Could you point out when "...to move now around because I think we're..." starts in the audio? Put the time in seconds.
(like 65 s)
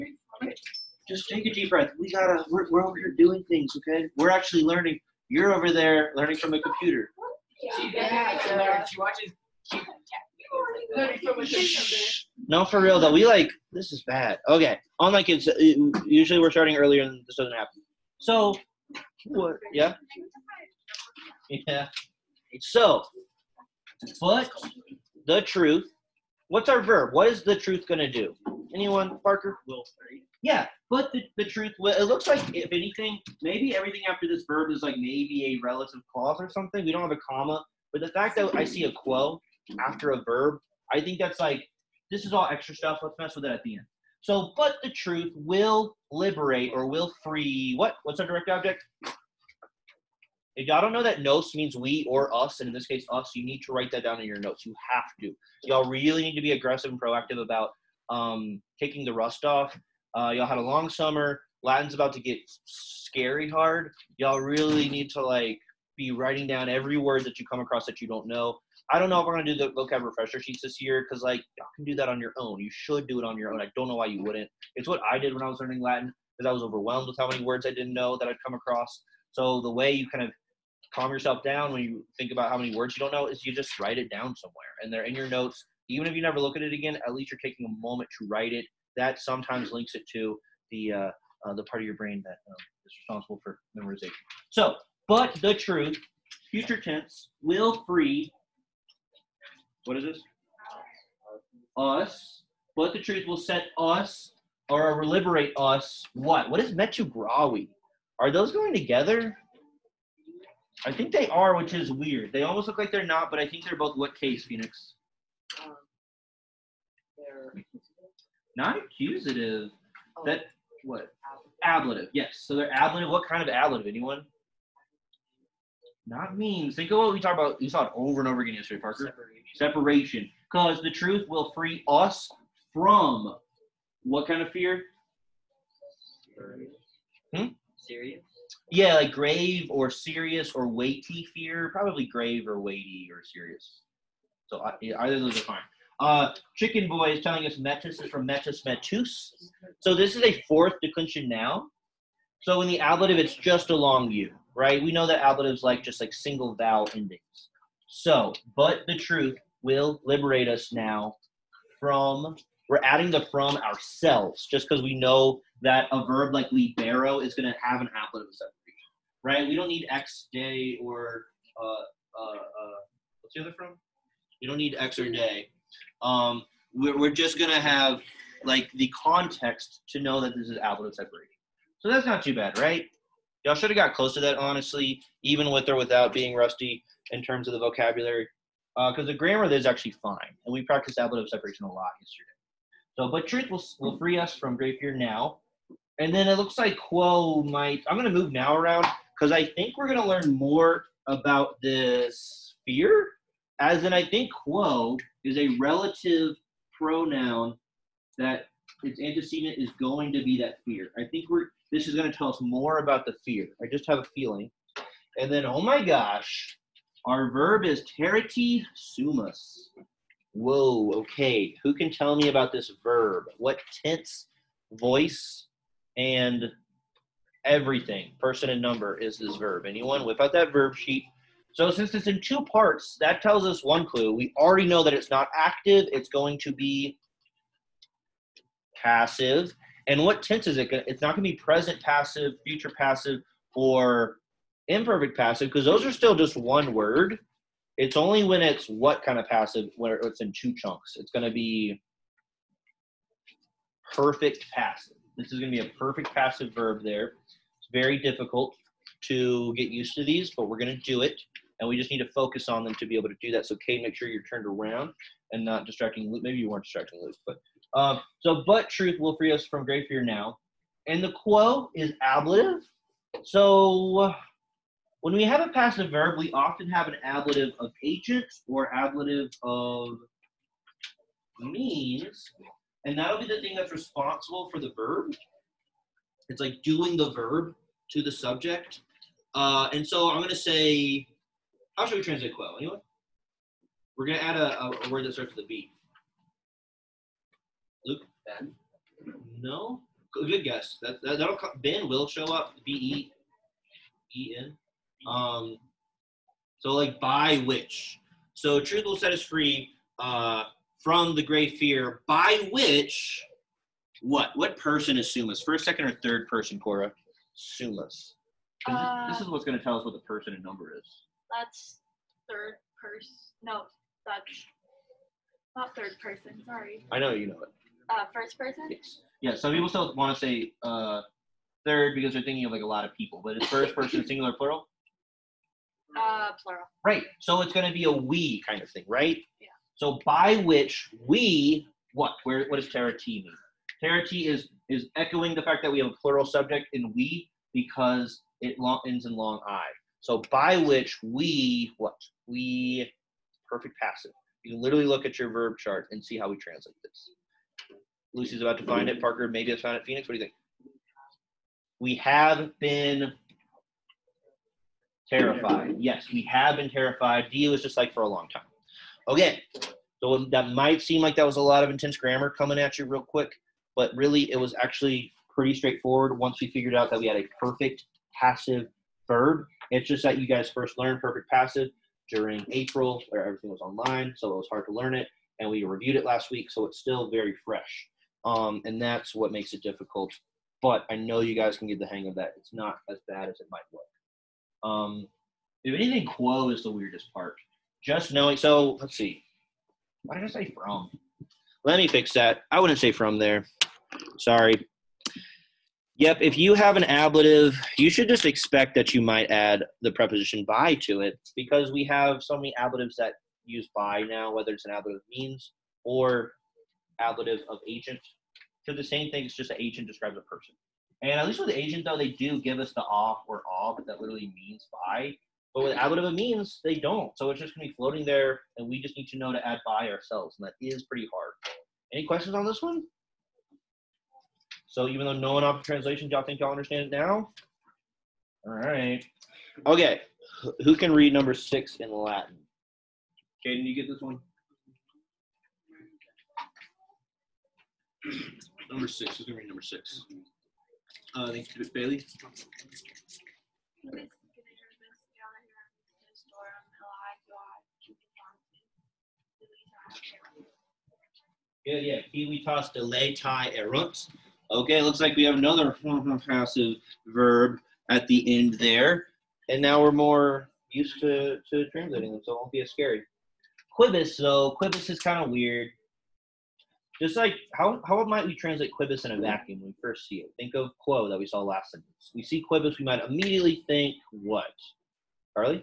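198 s.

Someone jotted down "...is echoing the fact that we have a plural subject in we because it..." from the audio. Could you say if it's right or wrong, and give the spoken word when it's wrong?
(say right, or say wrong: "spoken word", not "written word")
right.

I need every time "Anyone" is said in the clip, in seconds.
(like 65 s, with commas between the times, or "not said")
28 s, 123 s, 229 s, 292 s.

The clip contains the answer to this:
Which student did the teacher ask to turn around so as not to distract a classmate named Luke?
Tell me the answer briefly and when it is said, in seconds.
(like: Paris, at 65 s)
Kate, at 263 s.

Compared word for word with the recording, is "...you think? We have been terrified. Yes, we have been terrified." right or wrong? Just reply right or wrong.
right.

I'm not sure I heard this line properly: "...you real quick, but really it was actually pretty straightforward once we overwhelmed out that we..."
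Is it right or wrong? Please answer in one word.
wrong.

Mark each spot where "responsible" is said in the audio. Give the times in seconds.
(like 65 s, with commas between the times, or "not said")
93 s, 283 s.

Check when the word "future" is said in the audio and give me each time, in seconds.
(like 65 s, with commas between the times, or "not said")
96 s, 242 s.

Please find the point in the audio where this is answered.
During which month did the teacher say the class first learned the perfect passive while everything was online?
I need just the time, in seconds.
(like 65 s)
382 s.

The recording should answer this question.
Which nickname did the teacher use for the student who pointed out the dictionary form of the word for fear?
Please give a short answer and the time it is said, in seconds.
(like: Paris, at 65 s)
Chicken Boy, at 146 s.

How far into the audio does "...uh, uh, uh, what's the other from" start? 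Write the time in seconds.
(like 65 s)
171 s.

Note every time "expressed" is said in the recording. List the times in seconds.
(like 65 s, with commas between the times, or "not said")
not said.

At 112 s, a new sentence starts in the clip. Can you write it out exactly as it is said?
They almost look like they're not, but I think they're both what case, Phoenix?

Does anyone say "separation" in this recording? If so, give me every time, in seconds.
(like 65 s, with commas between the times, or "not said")
129 s, 168 s, 180 s, 191 s.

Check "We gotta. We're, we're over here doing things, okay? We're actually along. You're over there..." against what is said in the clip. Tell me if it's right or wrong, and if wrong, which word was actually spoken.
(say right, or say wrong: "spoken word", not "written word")
wrong: "learning", not "along".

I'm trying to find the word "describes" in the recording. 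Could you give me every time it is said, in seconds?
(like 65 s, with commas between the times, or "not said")
419 s.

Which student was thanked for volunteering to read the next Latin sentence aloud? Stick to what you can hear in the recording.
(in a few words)
Bailey.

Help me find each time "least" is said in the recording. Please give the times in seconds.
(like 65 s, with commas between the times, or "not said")
87 s, 421 s.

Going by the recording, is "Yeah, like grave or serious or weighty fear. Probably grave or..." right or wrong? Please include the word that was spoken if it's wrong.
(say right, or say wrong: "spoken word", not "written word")
right.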